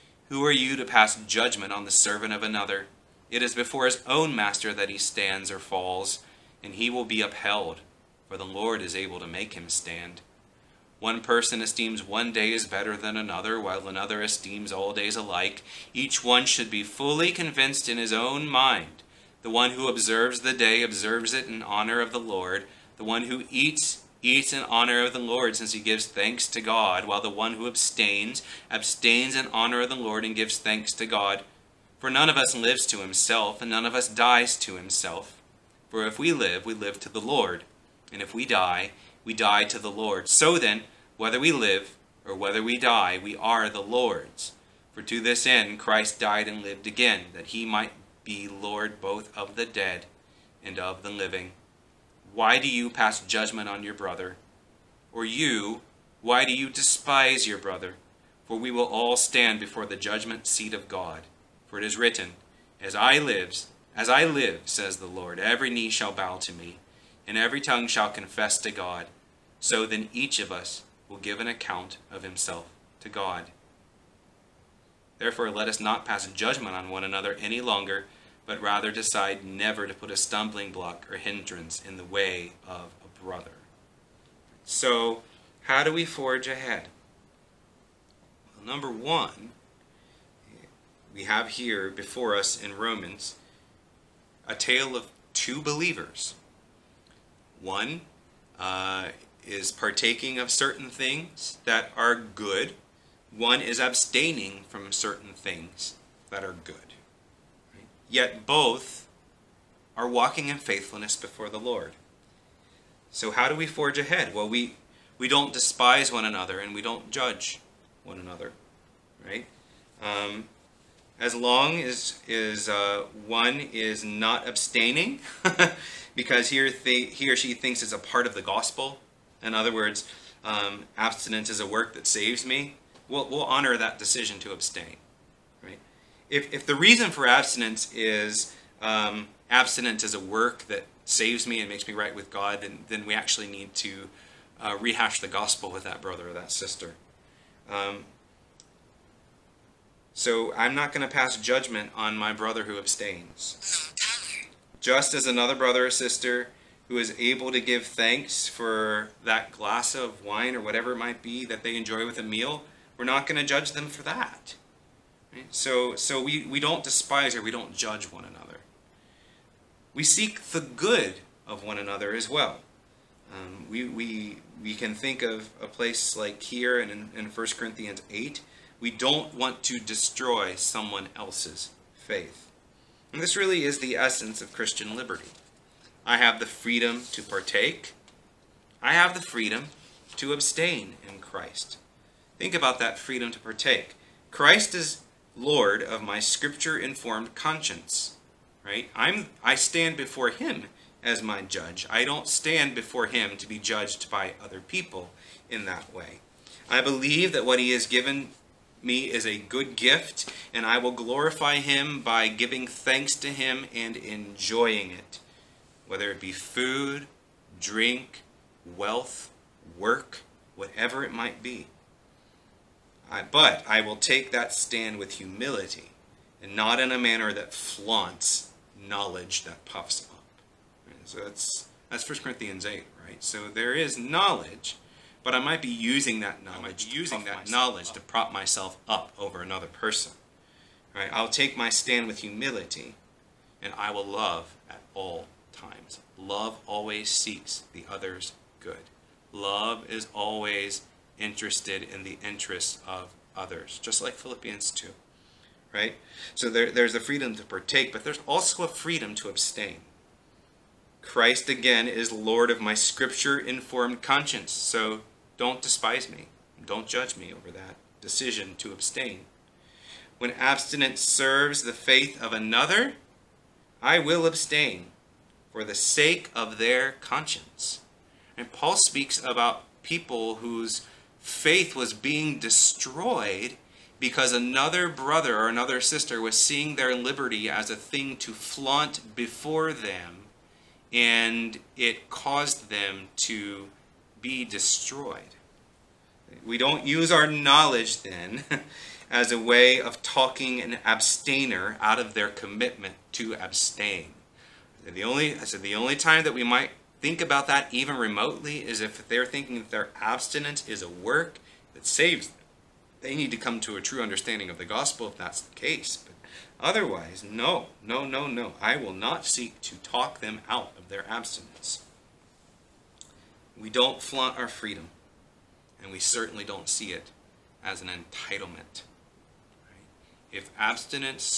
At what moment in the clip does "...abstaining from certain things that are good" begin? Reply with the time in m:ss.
1:43.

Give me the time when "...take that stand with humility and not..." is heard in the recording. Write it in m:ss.
3:43.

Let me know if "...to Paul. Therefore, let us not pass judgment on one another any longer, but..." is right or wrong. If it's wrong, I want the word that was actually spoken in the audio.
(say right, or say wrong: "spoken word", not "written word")
wrong: "God", not "Paul".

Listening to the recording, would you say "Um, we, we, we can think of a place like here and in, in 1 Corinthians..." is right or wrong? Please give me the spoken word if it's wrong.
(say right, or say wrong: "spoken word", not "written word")
right.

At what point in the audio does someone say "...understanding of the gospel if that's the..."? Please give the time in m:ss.
5:14.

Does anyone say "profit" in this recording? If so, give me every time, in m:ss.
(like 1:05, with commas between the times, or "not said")
not said.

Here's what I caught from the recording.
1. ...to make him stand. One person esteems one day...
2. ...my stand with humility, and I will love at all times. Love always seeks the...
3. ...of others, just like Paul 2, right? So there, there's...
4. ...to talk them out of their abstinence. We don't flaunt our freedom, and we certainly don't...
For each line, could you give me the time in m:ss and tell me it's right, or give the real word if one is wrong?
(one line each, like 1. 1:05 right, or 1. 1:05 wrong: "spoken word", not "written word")
1. 0:09 right
2. 4:01 right
3. 4:12 wrong: "Philippians", not "Paul"
4. 5:19 right.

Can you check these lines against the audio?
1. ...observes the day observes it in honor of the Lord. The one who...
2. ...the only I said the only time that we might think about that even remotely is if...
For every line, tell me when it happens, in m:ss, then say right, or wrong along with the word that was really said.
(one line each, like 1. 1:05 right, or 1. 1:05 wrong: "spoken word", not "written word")
1. 0:19 right
2. 5:04 right.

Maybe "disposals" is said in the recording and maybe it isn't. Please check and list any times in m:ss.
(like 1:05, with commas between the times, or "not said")
not said.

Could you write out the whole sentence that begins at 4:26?
Don't judge me over that decision to abstain.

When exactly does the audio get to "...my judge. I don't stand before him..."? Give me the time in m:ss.
3:21.